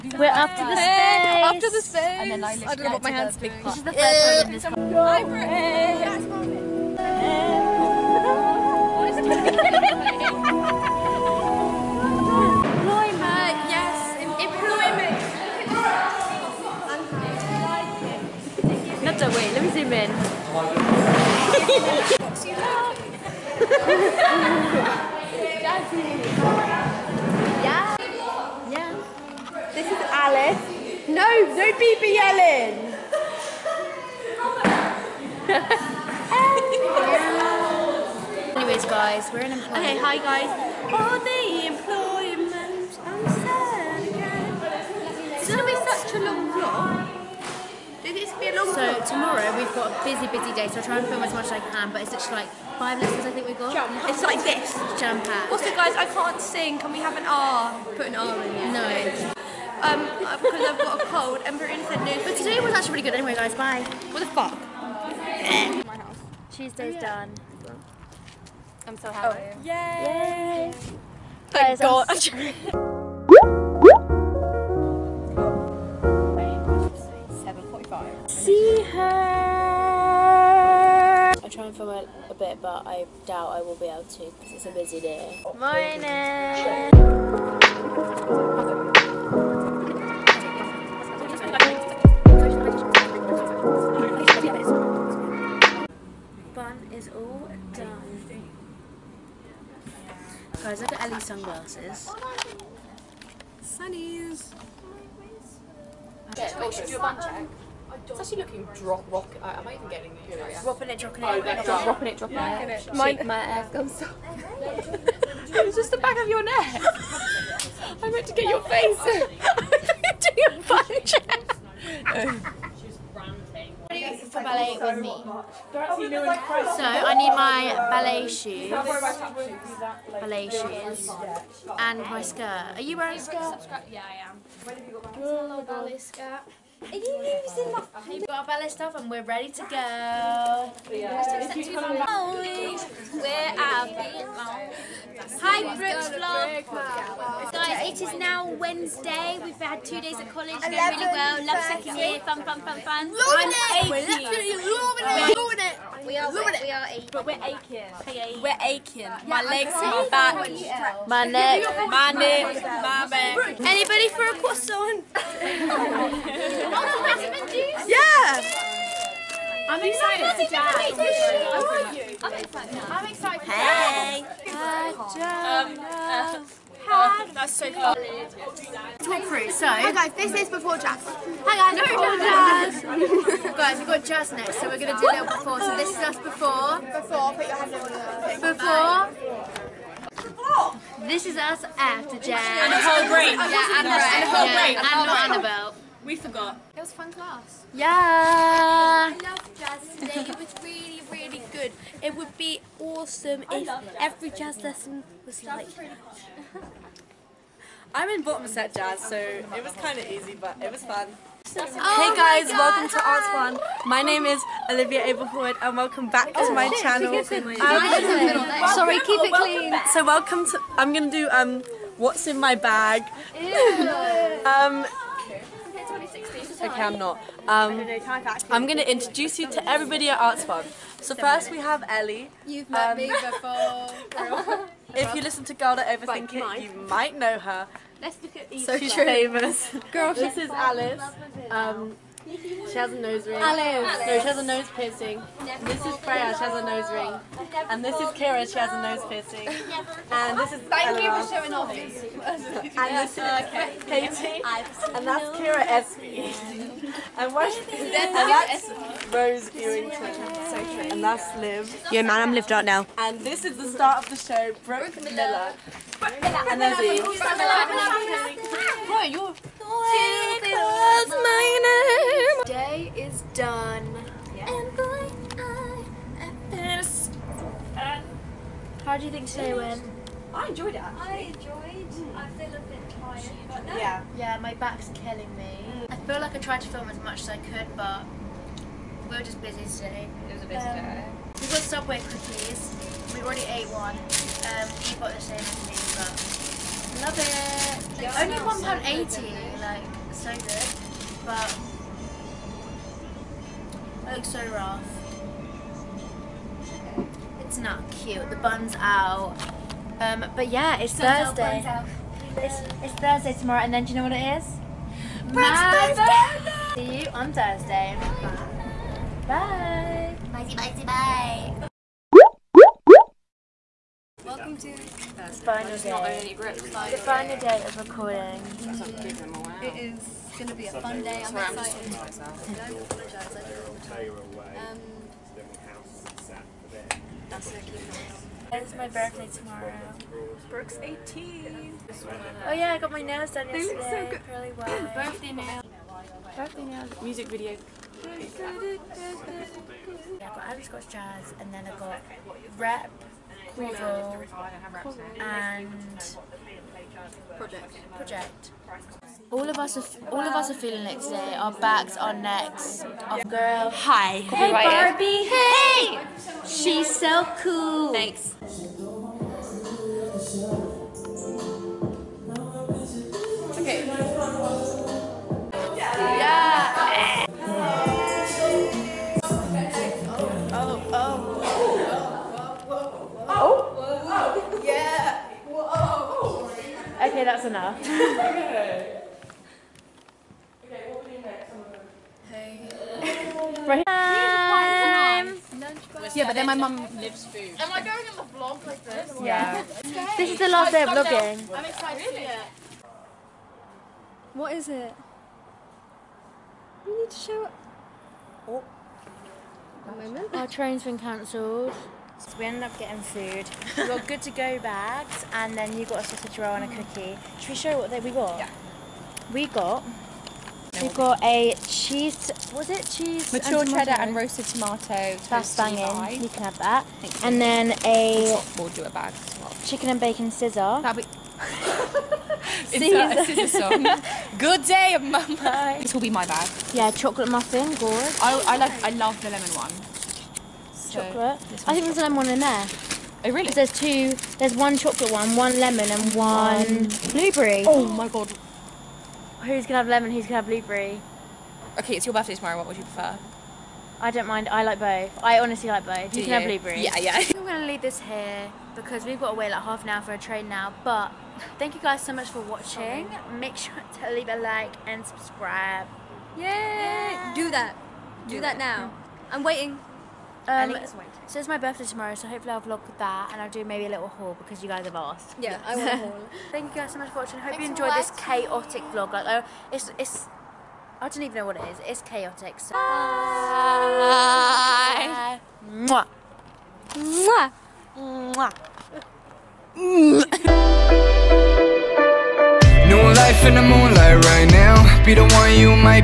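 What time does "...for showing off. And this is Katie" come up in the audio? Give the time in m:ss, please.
4:11.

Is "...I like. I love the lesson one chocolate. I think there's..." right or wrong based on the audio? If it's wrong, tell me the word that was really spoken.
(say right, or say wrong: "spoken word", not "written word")
wrong: "lemon", not "lesson".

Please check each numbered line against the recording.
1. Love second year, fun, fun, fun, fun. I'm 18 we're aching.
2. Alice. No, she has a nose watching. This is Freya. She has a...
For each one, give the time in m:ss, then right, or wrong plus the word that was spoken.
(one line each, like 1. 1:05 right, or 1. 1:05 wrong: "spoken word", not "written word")
1. 2:31 right
2. 4:03 wrong: "piercing", not "watching".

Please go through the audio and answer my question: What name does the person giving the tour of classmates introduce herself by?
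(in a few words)
Olivia Abelwood.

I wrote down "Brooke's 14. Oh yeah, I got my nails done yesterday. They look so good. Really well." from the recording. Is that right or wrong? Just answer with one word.
wrong.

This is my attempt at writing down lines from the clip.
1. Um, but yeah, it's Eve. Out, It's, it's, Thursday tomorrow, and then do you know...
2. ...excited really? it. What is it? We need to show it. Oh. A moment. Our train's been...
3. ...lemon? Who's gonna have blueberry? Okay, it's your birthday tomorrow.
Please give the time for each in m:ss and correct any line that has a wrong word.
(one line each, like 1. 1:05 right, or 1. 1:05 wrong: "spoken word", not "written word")
1. 5:09 wrong: "Thursday", not "Eve"
2. 6:41 right
3. 7:29 right.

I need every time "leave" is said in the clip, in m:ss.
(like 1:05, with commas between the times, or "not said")
7:37, 7:44.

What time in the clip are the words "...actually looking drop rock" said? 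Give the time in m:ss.
1:48.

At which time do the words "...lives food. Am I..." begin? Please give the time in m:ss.
6:36.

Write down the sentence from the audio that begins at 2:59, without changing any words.
So, hi guys, this is before Jazz.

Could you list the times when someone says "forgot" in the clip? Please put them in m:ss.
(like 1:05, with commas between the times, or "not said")
3:16.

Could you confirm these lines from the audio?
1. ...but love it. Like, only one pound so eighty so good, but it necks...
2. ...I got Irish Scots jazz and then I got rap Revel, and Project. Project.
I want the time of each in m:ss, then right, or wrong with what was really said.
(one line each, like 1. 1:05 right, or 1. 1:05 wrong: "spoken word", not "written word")
1. 4:55 wrong: "looks", not "necks"
2. 5:50 right.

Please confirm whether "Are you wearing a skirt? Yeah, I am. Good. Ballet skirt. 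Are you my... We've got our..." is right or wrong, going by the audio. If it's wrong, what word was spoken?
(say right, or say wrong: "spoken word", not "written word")
right.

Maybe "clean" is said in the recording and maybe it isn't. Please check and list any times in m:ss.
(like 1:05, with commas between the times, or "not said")
3:39.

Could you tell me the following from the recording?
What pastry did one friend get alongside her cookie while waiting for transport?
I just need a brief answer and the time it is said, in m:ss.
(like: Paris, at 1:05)
sausage roll, at 6:56.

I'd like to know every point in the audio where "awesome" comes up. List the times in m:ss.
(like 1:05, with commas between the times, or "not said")
3:22.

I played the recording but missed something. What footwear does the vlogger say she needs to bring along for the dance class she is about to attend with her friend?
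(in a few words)
ballet shoes.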